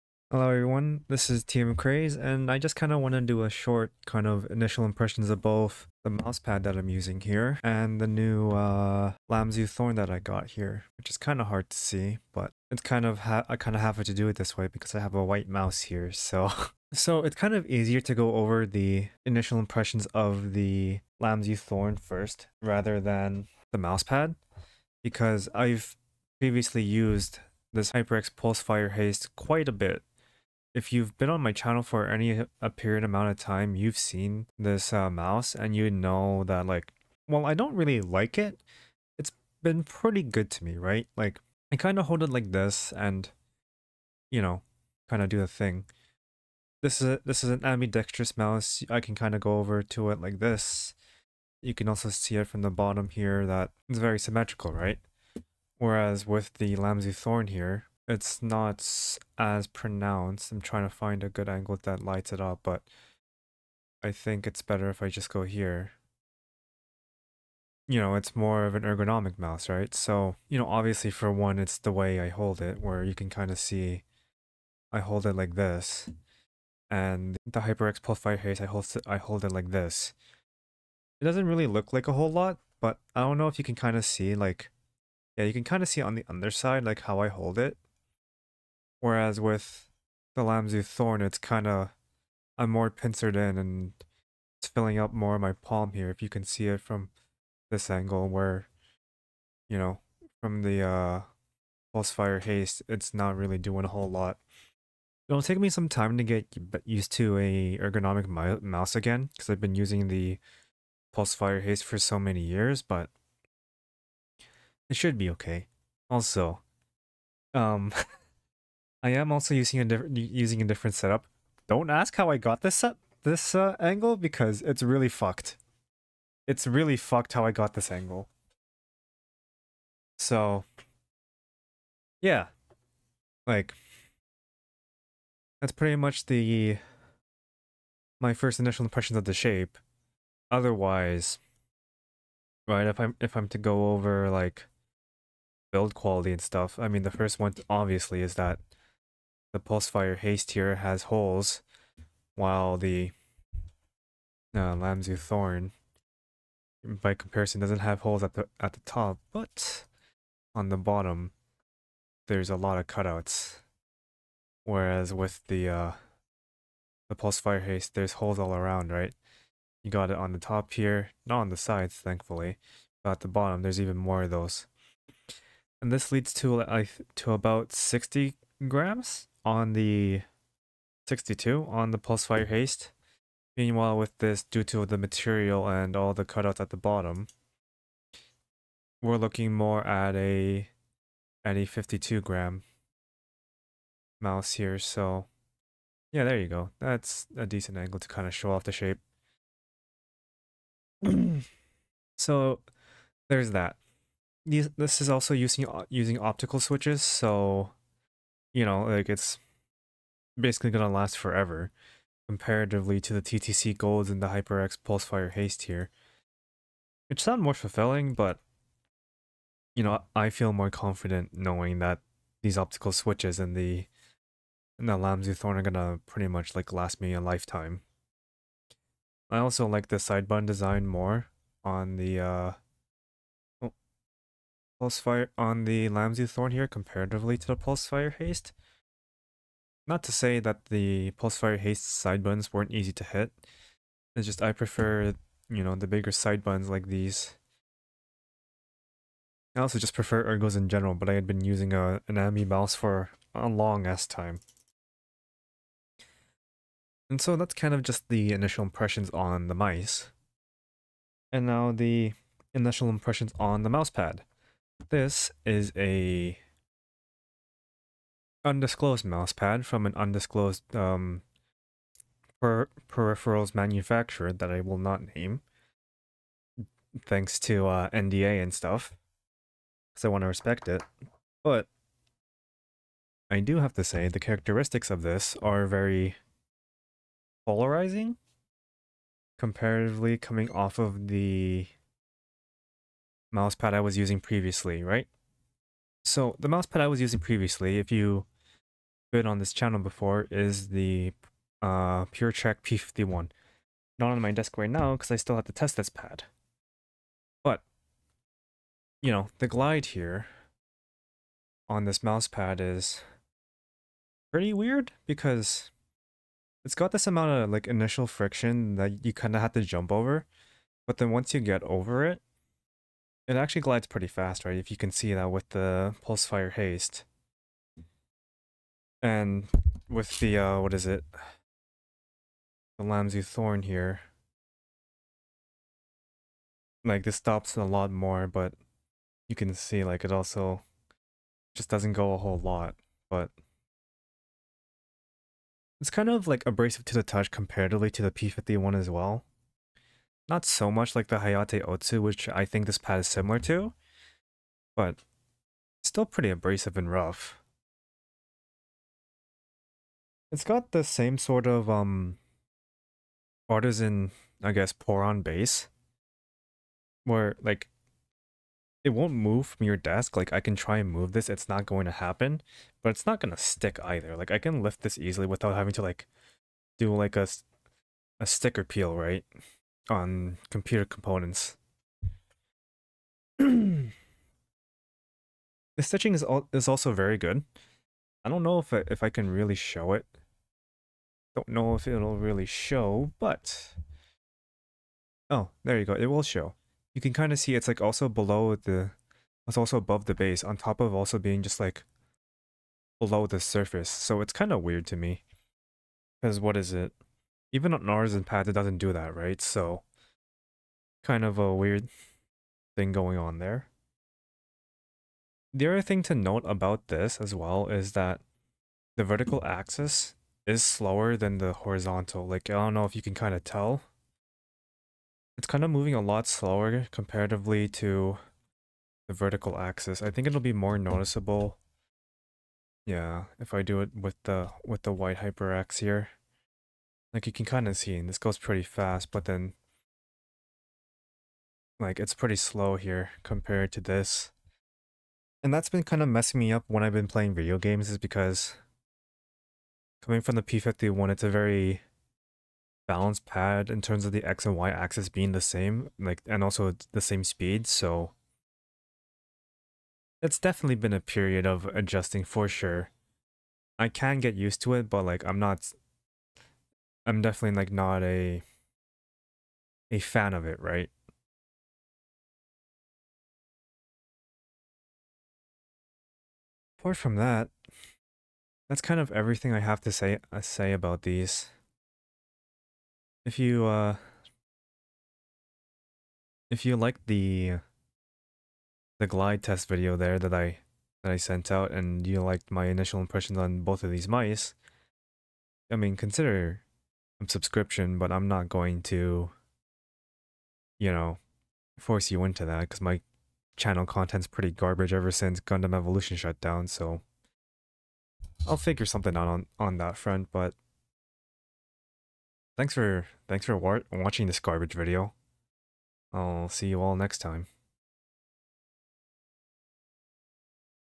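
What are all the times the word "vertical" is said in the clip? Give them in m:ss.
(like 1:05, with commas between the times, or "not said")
6:59, 7:09.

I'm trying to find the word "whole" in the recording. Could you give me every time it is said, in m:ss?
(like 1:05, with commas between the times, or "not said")
1:22, 1:43, 5:42.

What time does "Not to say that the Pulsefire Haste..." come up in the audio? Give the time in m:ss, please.
3:59.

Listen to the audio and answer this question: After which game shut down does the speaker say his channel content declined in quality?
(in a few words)
Gundam Evolution.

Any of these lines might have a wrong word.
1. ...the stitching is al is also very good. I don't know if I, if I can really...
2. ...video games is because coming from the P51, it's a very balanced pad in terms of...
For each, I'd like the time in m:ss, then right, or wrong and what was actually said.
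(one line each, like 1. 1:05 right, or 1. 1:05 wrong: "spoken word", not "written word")
1. 6:23 right
2. 7:27 right.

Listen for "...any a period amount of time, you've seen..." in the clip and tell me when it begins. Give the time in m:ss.
0:32.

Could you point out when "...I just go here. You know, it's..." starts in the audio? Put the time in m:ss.
1:05.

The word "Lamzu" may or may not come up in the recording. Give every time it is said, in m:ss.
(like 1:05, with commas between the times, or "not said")
0:09, 0:21, 0:56, 1:30, 2:34, 3:44, 3:55, 5:32.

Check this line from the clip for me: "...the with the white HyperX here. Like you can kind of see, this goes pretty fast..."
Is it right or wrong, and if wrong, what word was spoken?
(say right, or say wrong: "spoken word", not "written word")
right.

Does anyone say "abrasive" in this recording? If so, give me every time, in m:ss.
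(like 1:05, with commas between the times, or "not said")
5:46, 5:56.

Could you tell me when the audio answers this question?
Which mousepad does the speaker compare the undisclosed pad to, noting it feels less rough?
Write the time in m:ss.
5:51.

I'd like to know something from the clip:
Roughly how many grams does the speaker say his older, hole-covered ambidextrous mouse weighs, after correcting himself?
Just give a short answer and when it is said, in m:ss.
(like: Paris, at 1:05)
62, at 3:01.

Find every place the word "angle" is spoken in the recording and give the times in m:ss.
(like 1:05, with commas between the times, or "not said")
1:01, 1:37, 2:03, 2:07, 3:17.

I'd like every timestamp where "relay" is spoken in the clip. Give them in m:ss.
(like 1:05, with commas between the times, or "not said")
not said.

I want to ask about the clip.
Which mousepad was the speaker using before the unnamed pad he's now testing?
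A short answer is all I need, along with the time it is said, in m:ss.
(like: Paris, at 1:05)
PureTrack P51, at 5:02.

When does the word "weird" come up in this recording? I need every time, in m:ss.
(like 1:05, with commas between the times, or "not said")
5:14, 6:44, 6:51.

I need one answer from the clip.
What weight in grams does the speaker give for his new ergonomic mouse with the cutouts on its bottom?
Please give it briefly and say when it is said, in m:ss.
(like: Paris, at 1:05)
52, at 3:11.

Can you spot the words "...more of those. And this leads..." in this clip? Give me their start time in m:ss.
2:53.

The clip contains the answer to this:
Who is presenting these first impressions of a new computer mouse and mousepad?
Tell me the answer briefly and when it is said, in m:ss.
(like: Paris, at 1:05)
TMCraze, at 0:01.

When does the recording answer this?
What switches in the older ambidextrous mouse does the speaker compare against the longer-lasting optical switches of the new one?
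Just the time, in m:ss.
3:33.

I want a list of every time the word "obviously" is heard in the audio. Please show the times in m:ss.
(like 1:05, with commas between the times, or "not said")
1:10, 2:27.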